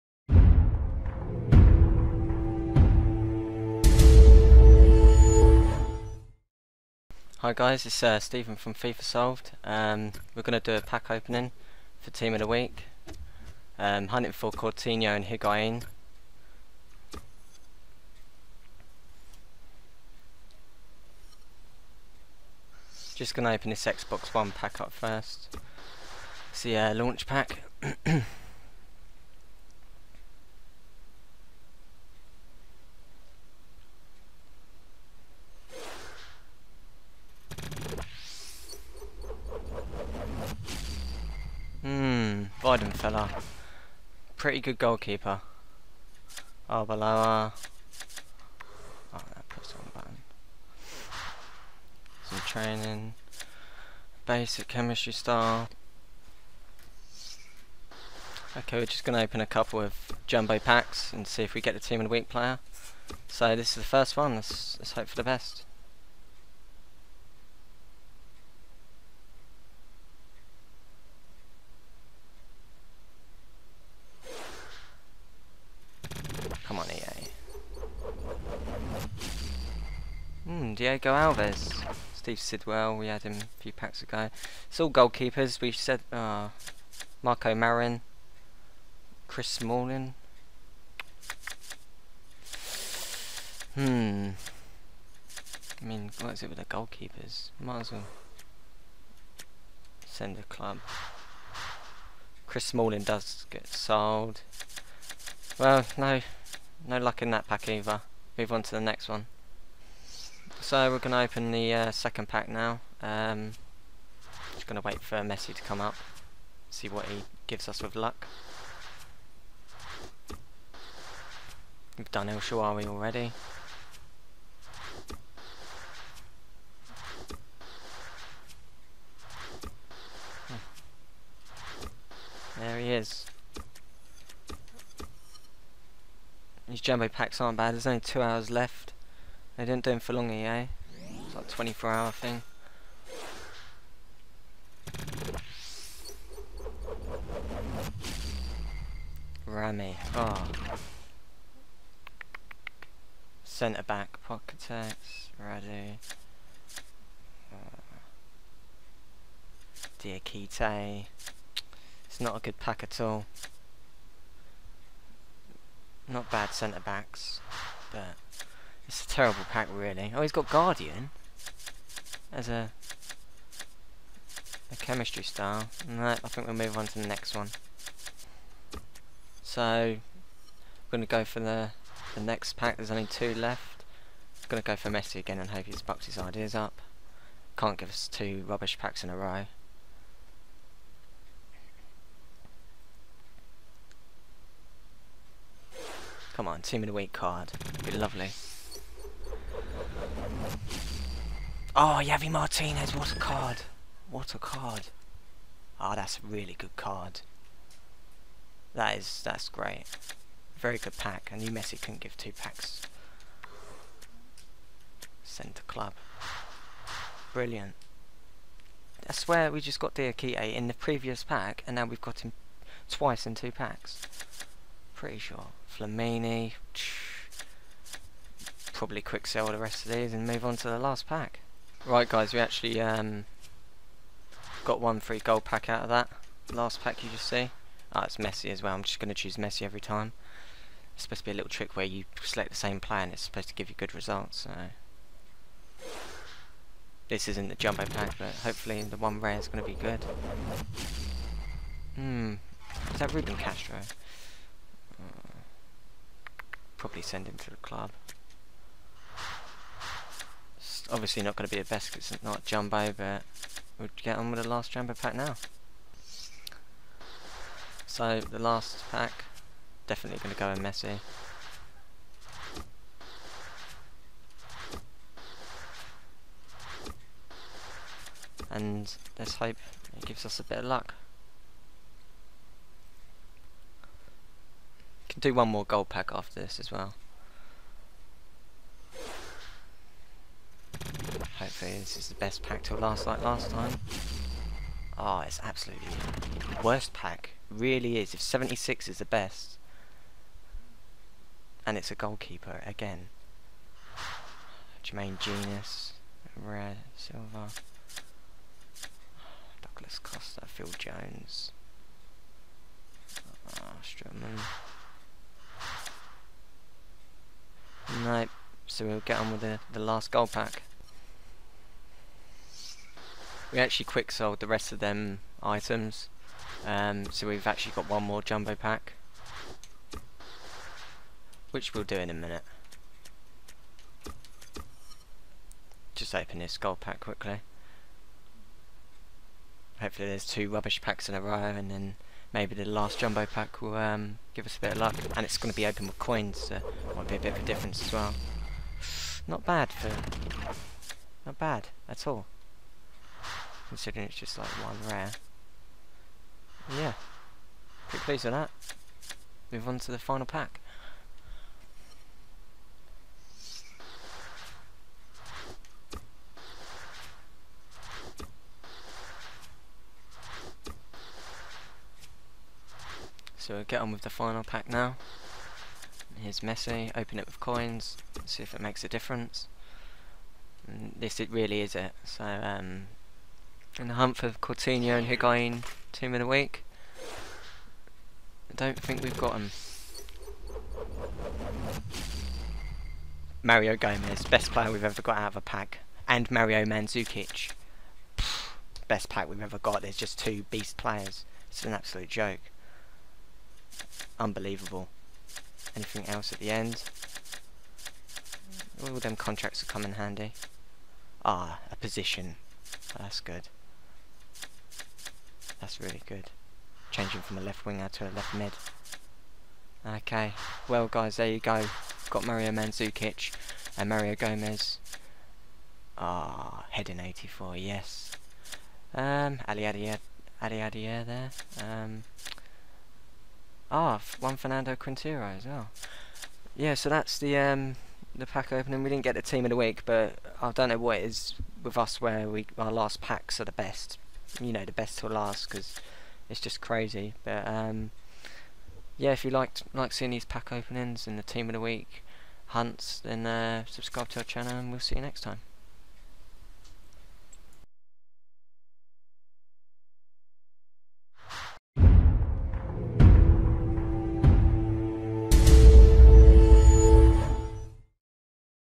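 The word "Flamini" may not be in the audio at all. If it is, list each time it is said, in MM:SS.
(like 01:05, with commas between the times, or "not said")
03:45.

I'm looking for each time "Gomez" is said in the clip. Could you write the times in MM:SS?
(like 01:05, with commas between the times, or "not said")
06:33, 07:04.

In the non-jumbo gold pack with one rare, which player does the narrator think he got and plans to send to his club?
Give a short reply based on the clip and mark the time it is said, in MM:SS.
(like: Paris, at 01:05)
Ruben Castro, at 04:13.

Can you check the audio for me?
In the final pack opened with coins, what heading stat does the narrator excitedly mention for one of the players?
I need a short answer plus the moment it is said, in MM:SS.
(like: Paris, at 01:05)
84, at 07:06.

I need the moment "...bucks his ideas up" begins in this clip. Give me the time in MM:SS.
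03:05.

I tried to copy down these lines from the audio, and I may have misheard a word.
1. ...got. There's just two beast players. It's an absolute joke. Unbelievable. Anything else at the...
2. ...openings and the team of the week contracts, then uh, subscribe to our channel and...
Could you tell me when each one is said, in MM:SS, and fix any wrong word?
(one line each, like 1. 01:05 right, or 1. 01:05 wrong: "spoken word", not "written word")
1. 06:39 right
2. 07:30 wrong: "hunts", not "contracts".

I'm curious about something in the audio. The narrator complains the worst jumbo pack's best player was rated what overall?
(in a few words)
76.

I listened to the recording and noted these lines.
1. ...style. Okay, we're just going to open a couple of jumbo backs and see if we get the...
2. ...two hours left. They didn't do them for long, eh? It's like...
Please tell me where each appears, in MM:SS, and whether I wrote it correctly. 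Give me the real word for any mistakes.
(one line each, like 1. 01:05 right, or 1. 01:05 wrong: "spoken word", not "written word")
1. 00:55 wrong: "packs", not "backs"
2. 02:17 right.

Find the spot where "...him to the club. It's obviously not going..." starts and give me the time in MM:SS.
04:17.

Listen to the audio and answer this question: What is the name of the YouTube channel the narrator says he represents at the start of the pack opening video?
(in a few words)
FIFA Solved.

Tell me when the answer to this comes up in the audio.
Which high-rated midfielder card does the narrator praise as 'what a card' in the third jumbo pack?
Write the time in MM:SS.
03:22.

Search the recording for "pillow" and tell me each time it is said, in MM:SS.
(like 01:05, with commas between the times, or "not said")
not said.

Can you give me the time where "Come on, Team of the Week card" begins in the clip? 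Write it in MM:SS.
03:16.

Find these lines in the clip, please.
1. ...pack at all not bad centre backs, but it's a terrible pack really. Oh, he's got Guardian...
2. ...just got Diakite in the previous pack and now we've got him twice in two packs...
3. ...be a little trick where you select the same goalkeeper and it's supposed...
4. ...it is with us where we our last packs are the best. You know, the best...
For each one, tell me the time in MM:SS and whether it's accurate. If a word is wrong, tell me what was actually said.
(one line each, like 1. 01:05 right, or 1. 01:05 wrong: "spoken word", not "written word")
1. 02:42 right
2. 03:39 right
3. 04:01 wrong: "player", not "goalkeeper"
4. 07:20 right.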